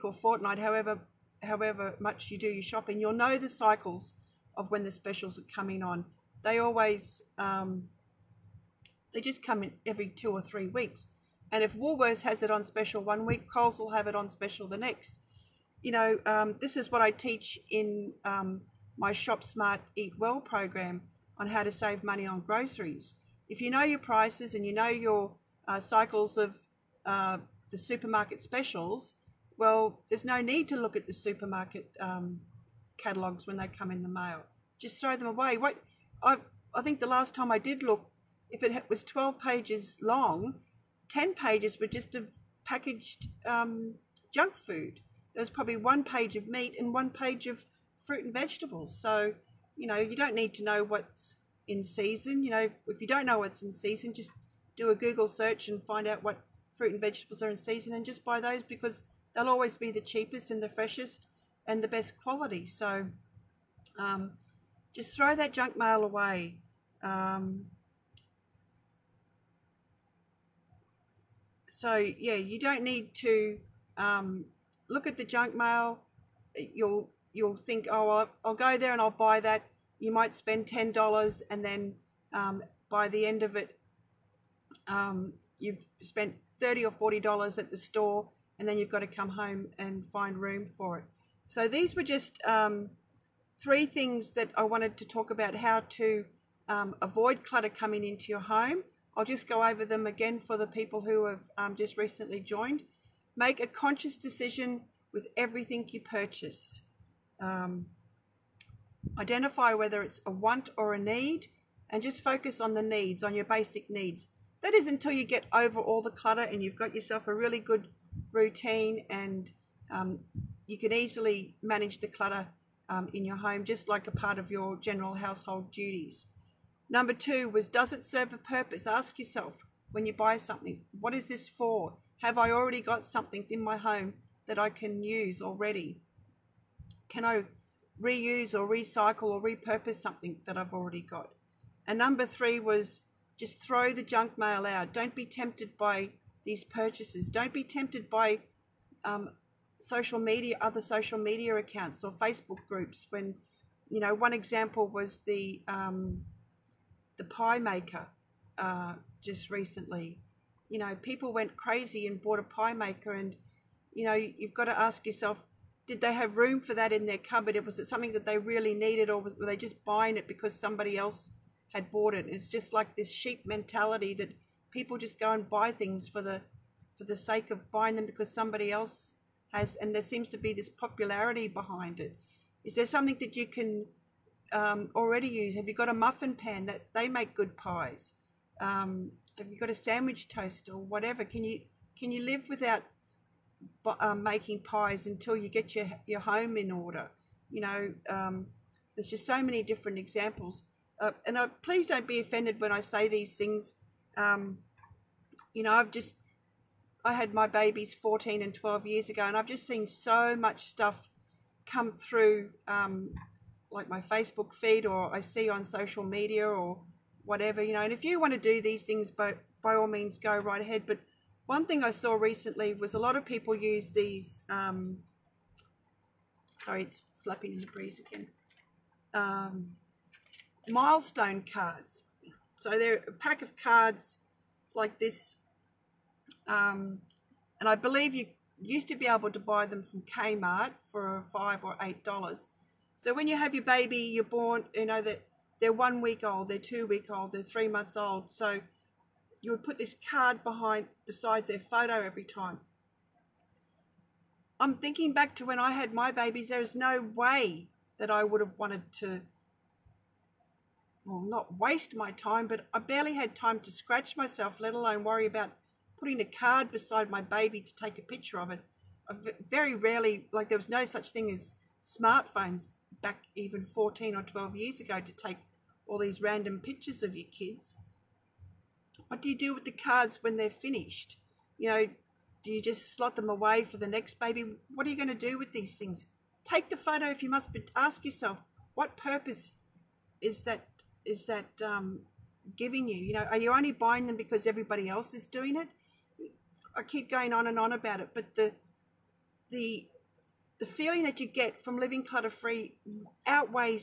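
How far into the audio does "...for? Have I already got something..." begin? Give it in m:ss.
2:11.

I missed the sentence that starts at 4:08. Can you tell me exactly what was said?
So you would put this card behind beside their photo every time.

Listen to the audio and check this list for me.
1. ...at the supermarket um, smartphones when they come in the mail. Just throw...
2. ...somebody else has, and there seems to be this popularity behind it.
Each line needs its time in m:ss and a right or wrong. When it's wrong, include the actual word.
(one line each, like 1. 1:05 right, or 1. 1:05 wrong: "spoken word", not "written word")
1. 0:30 wrong: "catalogues", not "smartphones"
2. 2:58 right.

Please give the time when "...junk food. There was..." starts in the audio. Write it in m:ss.
0:44.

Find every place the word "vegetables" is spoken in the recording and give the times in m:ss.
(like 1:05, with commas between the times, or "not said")
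0:48, 0:56.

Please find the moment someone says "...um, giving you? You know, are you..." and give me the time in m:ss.
4:51.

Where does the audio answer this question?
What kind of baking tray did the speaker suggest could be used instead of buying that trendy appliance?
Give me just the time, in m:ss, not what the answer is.
3:05.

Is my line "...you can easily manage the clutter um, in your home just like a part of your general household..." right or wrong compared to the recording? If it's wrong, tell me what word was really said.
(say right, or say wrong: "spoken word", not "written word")
right.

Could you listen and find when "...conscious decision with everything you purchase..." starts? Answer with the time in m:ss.
1:43.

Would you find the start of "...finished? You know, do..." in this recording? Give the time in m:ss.
4:40.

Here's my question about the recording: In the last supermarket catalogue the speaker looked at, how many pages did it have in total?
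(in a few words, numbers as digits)
12.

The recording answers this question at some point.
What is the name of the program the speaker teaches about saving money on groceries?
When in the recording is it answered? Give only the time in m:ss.
0:19.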